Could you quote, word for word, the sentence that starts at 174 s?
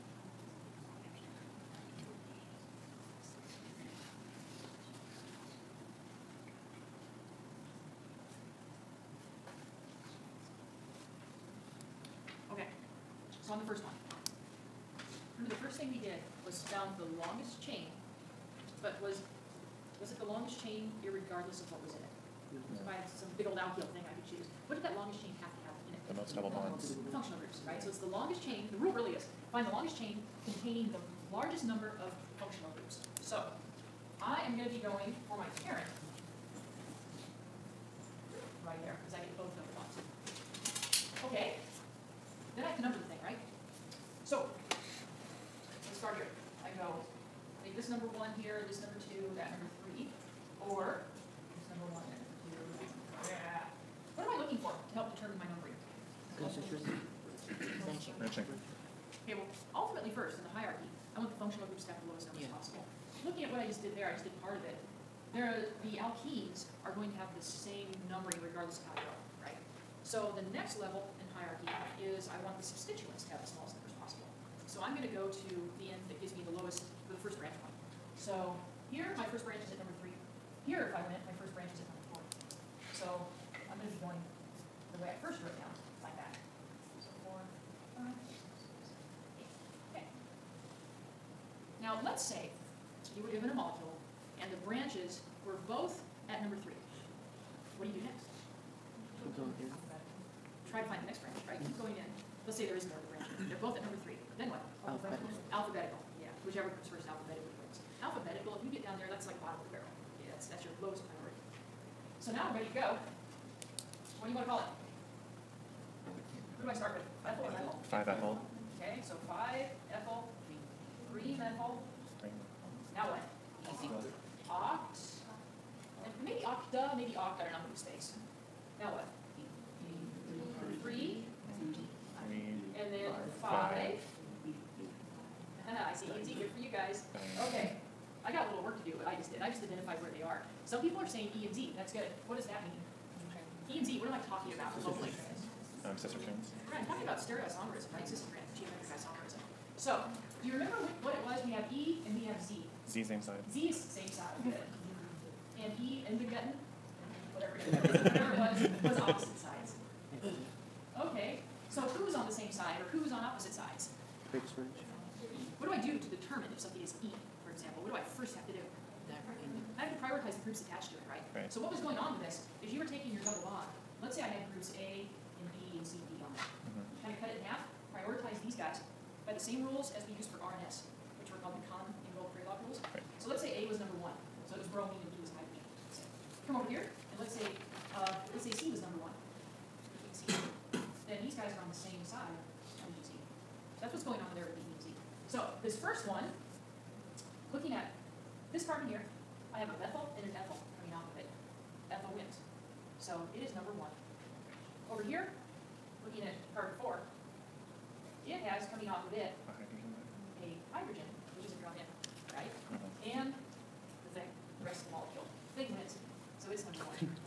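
Let's say I had groups A and B and C and D on it.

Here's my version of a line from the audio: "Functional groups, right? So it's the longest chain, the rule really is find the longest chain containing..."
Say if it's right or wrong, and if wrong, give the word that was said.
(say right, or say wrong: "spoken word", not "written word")
right.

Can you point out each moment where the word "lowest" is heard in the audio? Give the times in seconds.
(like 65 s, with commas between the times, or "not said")
62 s, 76 s, 110 s.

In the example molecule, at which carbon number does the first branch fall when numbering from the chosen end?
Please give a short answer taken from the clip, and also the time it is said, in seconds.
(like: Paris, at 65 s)
4, at 81 s.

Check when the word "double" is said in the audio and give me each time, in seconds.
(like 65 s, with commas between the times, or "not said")
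26 s, 173 s.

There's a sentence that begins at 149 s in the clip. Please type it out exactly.
So, do you remember what, what it was?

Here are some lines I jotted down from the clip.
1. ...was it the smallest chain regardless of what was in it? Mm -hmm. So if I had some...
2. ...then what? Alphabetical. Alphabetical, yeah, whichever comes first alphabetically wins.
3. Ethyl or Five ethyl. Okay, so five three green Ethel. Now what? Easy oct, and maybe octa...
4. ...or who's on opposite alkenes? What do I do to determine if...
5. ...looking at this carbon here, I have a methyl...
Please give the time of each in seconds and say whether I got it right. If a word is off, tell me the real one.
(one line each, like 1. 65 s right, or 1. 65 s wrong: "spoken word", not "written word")
1. 20 s wrong: "longest", not "smallest"
2. 104 s right
3. 117 s right
4. 162 s wrong: "sides", not "alkenes"
5. 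197 s right.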